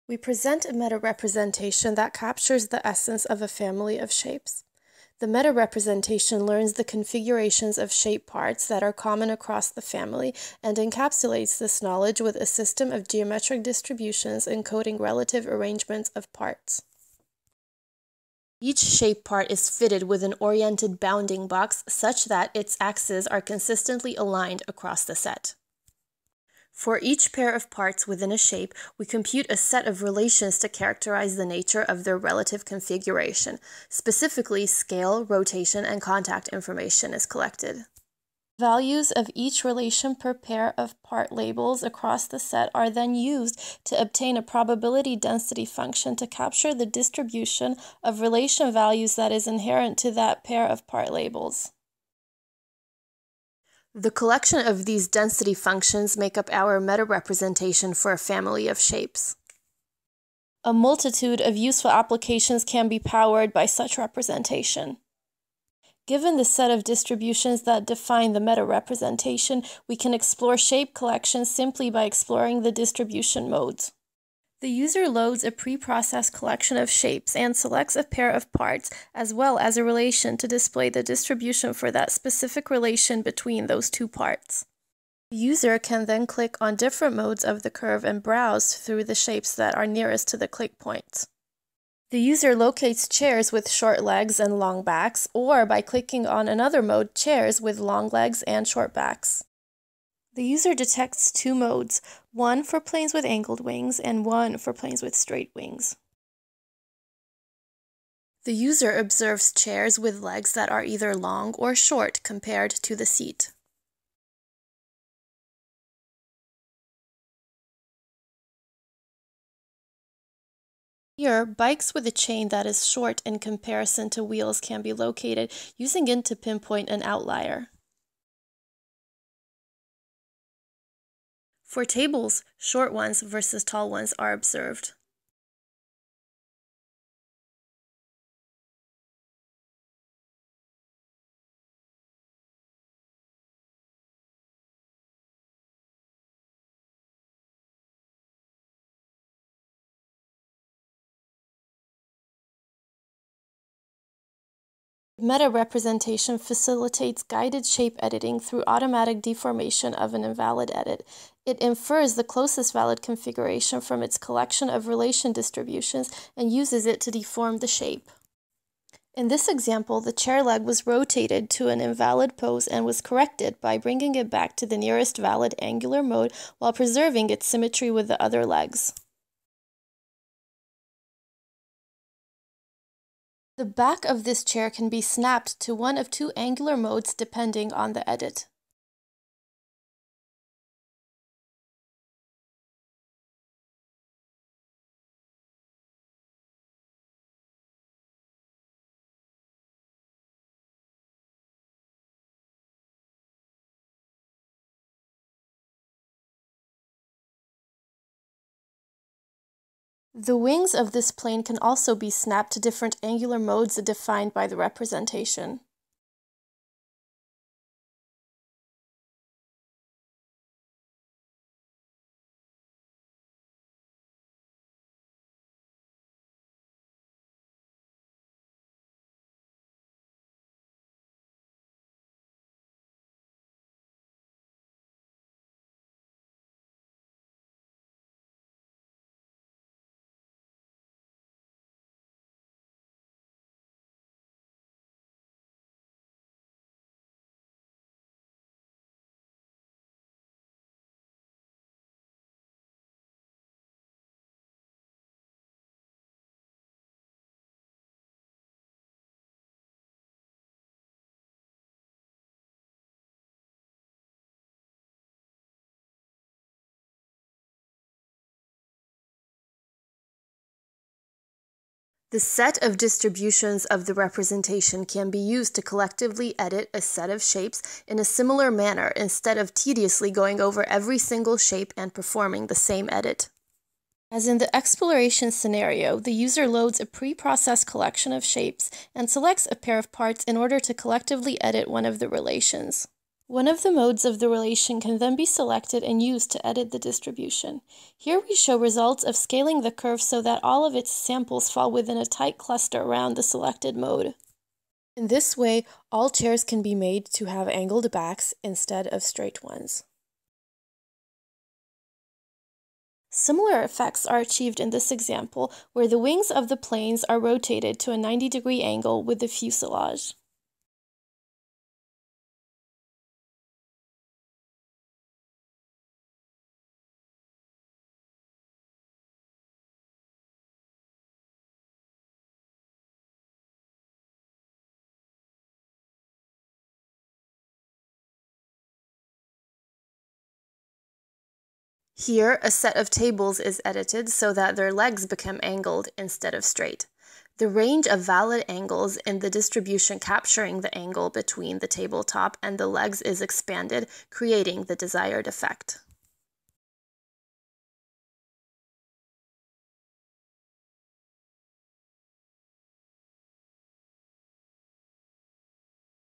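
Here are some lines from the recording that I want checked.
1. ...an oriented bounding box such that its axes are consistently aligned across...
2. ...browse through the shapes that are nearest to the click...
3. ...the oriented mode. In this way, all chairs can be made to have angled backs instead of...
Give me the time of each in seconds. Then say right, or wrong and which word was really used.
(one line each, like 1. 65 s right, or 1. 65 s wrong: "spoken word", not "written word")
1. 20 s right
2. 88 s right
3. 303 s wrong: "selected", not "oriented".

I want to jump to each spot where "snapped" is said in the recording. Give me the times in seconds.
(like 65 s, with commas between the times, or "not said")
185 s, 212 s.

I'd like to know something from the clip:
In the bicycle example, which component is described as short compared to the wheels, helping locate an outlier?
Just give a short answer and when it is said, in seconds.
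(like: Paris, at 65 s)
chain, at 122 s.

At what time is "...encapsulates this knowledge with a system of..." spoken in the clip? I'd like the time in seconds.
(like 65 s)
10 s.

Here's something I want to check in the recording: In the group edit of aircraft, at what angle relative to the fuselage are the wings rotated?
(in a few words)
90 degrees.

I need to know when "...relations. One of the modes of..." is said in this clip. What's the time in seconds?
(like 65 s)
292 s.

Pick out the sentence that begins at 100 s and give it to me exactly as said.
The user detects two modes, one for planes with angled wings and one for planes with straight wings.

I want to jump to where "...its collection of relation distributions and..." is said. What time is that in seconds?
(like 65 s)
164 s.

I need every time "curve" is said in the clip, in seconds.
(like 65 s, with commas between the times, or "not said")
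87 s, 299 s.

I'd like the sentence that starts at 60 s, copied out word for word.
A multitude of useful applications can be powered by such representation.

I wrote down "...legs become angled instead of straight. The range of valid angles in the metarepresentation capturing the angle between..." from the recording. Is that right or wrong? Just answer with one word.
wrong.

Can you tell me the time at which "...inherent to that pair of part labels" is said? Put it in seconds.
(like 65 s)
49 s.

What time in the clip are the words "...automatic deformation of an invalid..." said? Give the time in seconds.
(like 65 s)
158 s.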